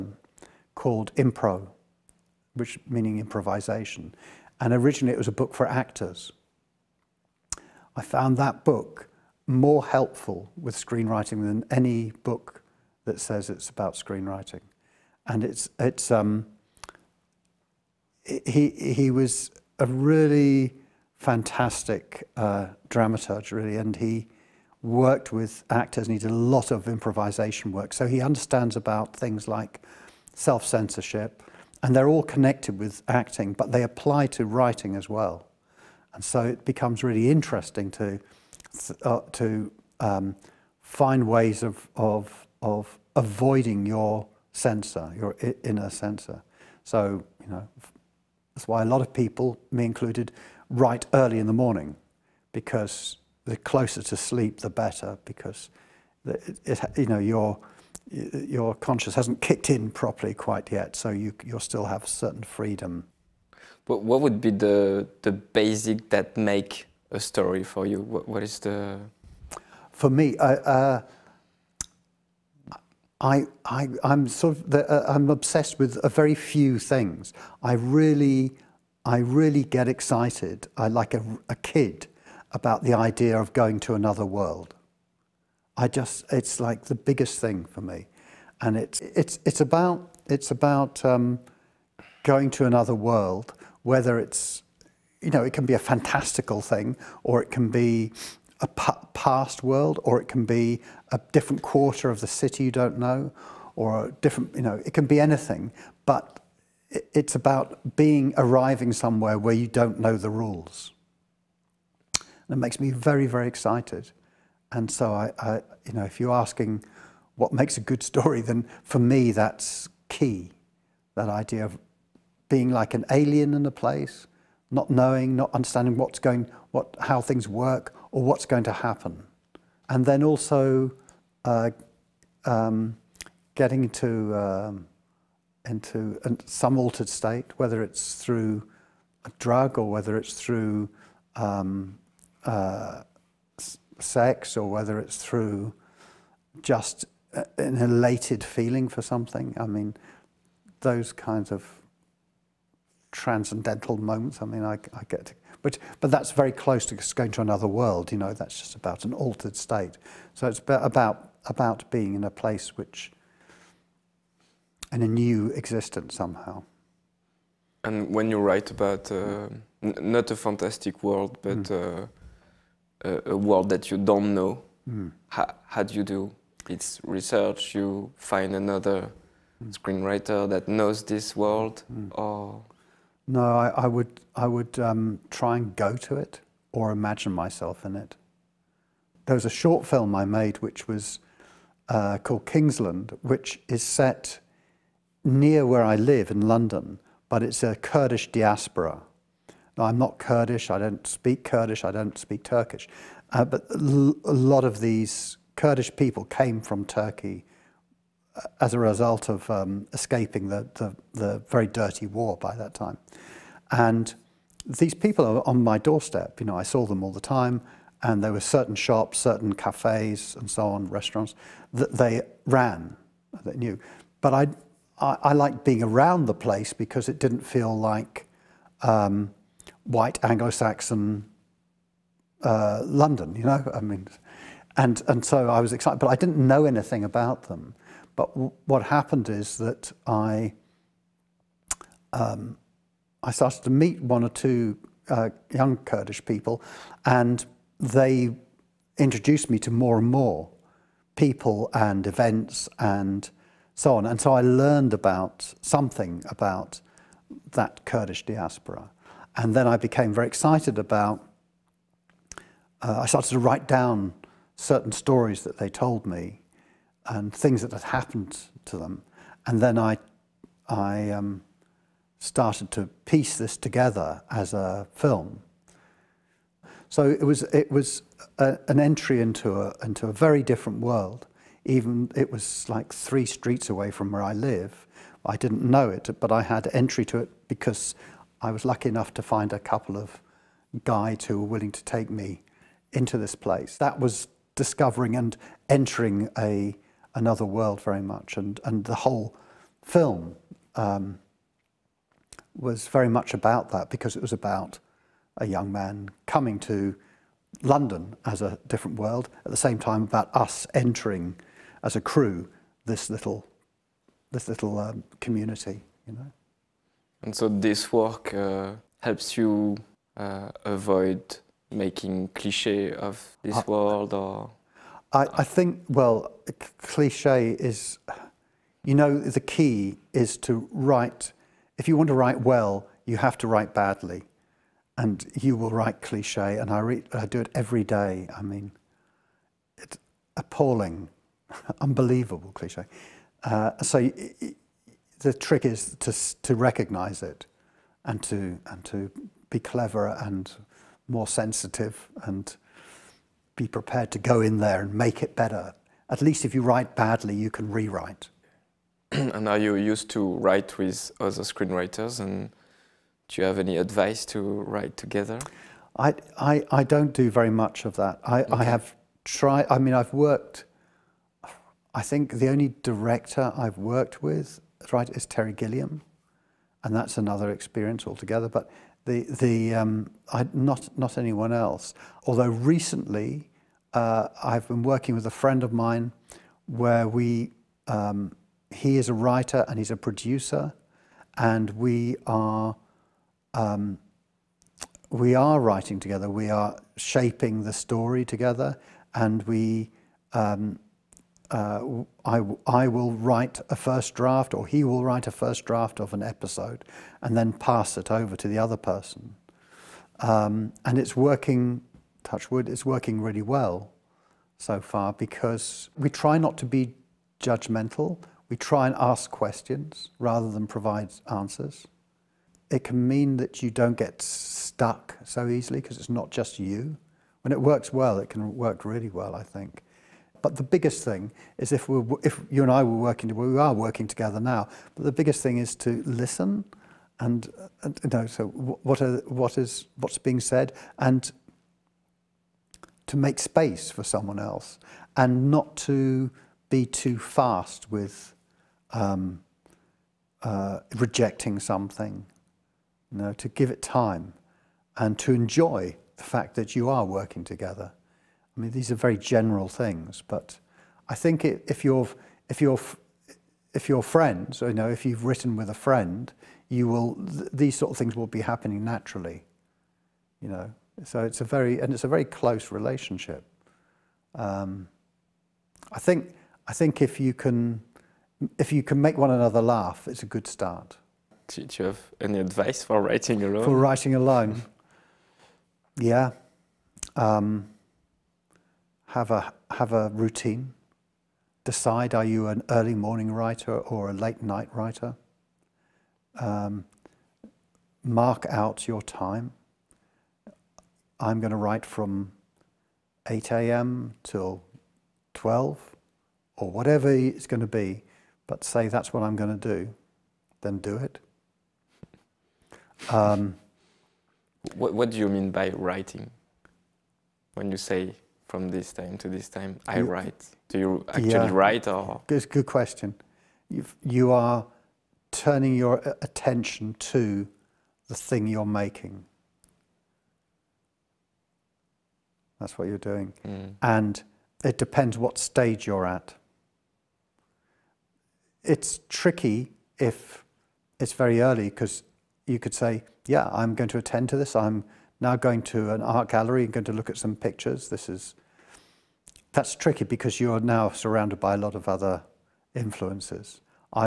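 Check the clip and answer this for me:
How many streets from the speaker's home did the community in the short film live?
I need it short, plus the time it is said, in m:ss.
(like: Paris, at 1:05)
3 streets, at 4:42.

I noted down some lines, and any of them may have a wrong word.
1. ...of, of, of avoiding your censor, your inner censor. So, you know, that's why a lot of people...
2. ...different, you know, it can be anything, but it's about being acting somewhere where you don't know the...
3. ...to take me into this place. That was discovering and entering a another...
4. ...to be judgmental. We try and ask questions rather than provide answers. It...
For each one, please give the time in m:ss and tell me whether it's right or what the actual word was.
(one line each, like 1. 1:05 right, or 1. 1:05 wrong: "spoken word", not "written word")
1. 0:41 right
2. 1:44 wrong: "arriving", not "acting"
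3. 4:51 right
4. 6:56 right.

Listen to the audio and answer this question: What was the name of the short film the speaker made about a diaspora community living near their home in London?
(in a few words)
Kingsland.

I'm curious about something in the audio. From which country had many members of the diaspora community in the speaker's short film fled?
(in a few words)
Turkey.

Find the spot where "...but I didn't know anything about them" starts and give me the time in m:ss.
3:55.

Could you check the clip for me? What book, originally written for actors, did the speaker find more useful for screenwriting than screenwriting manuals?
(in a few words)
Impro.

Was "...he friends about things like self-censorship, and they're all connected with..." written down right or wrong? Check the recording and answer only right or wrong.
wrong.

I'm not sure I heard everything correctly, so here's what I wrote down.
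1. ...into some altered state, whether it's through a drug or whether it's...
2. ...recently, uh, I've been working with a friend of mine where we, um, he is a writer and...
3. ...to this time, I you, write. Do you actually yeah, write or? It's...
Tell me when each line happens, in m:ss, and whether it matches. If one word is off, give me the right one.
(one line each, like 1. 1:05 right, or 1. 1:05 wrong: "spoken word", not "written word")
1. 2:15 right
2. 6:22 right
3. 8:39 right.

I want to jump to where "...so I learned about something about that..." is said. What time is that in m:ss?
4:14.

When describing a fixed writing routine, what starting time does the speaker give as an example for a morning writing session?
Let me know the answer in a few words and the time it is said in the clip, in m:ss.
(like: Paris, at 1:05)
8 a.m., at 8:23.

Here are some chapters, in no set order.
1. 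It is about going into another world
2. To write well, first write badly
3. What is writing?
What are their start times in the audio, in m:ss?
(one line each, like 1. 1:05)
1. 1:13
2. 5:28
3. 8:08.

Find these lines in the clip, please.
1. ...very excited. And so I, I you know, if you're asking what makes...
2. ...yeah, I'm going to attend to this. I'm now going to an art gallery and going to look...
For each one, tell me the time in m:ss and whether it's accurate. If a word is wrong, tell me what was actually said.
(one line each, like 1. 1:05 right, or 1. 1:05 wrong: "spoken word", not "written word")
1. 1:53 right
2. 9:03 right.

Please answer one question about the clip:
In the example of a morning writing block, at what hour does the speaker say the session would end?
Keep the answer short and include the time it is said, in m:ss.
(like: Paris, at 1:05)
12, at 8:25.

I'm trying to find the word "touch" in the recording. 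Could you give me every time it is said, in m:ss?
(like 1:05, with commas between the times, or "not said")
6:52.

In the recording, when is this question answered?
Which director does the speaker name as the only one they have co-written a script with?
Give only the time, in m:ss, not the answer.
6:15.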